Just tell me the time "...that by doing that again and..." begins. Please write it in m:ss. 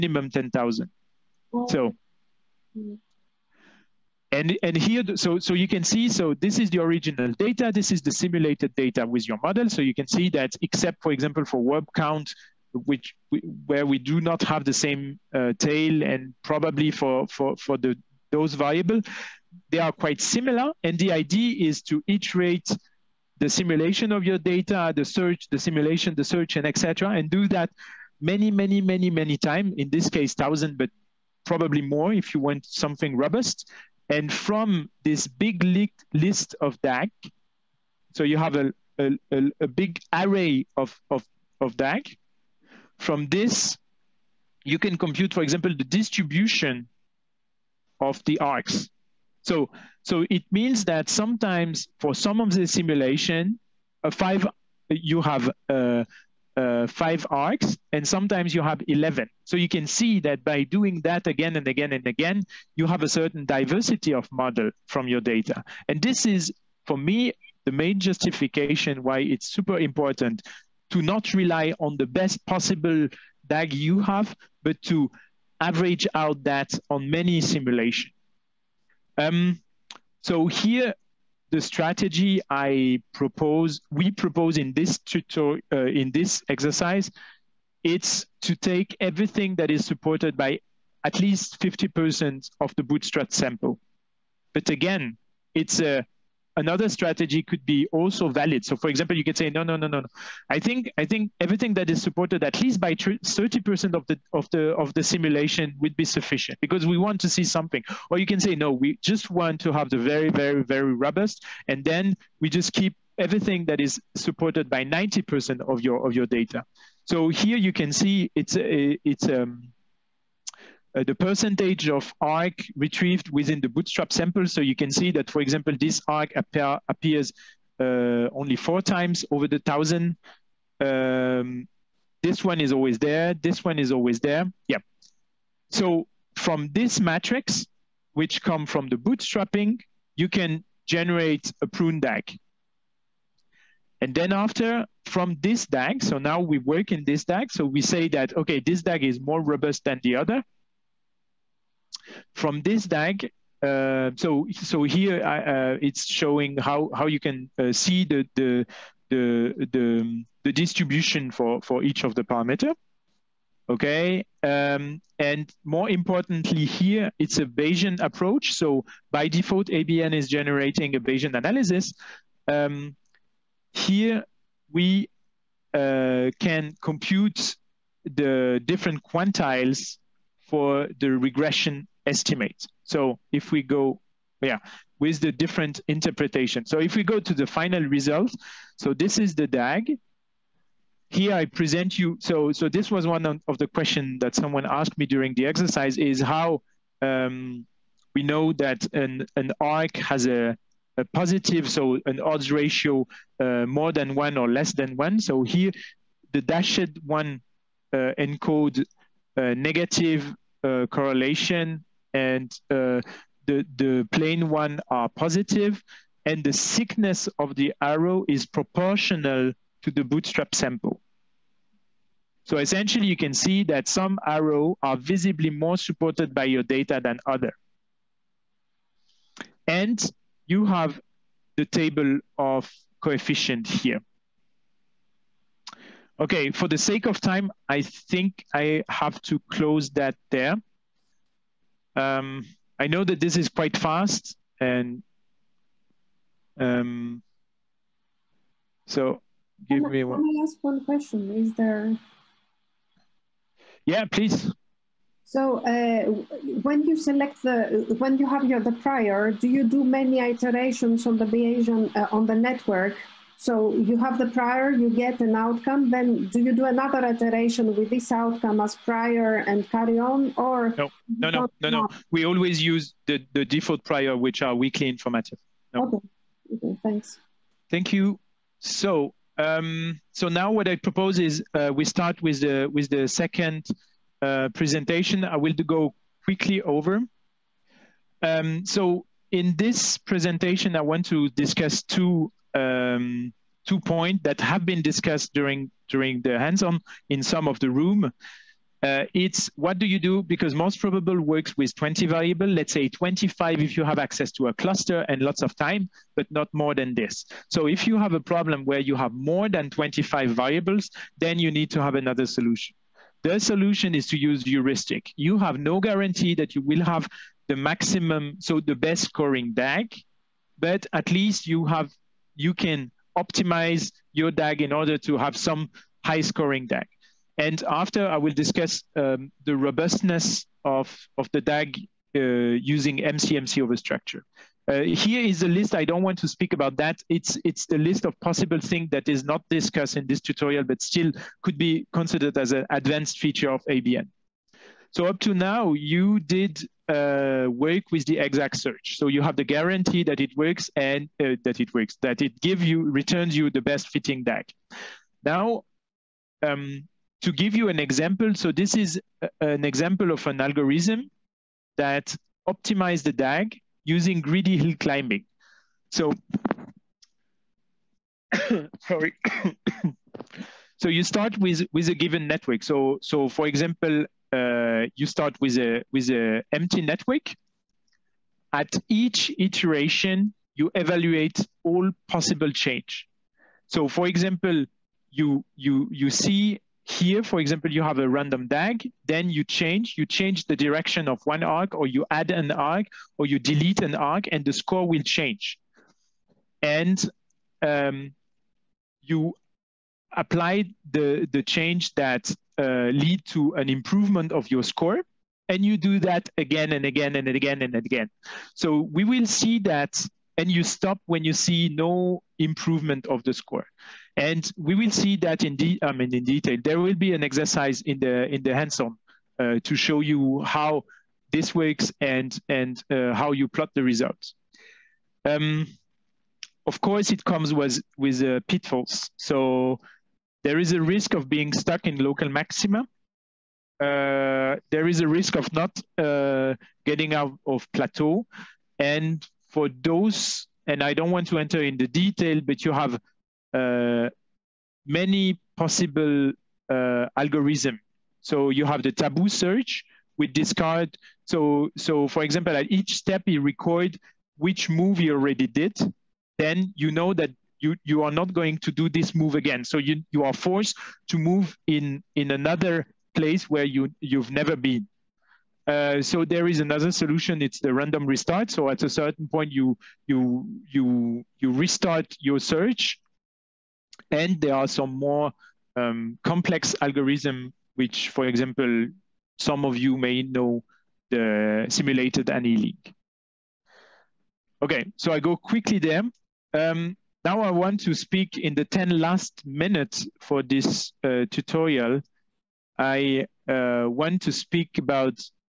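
1:00.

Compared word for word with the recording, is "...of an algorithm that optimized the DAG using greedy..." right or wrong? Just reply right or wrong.
right.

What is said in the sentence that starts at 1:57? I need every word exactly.
So here you can see it's a, it's um uh, the percentage of arc retrieved within the bootstrap sample.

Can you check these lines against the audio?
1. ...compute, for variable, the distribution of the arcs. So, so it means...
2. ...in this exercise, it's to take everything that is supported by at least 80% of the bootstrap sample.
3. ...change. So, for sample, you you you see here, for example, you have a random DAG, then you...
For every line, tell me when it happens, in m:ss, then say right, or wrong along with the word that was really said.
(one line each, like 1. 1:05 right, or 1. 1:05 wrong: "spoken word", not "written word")
1. 0:44 wrong: "example", not "variable"
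2. 1:25 wrong: "50", not "80"
3. 6:22 wrong: "example", not "sample".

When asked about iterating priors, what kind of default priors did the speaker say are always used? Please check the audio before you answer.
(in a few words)
weakly informative.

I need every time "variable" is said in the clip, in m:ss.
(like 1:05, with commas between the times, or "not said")
0:18, 5:02, 5:10.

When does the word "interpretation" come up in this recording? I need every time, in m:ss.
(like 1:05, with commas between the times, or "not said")
3:05.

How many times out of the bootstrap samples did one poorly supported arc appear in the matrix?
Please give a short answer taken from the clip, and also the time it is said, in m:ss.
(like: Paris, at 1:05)
4, at 2:08.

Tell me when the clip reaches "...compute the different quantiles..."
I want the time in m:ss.
2:56.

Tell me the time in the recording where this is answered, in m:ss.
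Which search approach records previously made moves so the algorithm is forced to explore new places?
7:28.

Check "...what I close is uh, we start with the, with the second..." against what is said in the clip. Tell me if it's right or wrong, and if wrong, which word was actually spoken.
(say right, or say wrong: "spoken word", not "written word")
wrong: "propose", not "close".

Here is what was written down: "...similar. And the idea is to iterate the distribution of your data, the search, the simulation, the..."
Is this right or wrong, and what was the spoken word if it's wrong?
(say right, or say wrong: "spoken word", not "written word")
wrong: "simulation", not "distribution".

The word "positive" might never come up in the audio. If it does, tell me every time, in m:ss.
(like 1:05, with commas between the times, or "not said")
3:21, 3:35.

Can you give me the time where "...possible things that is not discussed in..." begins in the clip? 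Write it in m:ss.
5:38.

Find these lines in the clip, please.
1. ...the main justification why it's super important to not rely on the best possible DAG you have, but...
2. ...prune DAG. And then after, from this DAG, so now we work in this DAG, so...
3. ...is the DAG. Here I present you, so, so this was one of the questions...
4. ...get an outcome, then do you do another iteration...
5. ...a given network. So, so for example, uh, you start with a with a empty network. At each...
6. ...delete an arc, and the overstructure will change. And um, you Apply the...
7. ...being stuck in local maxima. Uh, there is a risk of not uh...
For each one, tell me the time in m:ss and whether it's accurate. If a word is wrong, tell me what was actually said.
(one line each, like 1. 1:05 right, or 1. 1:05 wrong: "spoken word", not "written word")
1. 1:07 right
2. 2:21 right
3. 3:09 right
4. 4:24 right
5. 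6:11 right
6. 6:33 wrong: "score", not "overstructure"
7. 7:11 right.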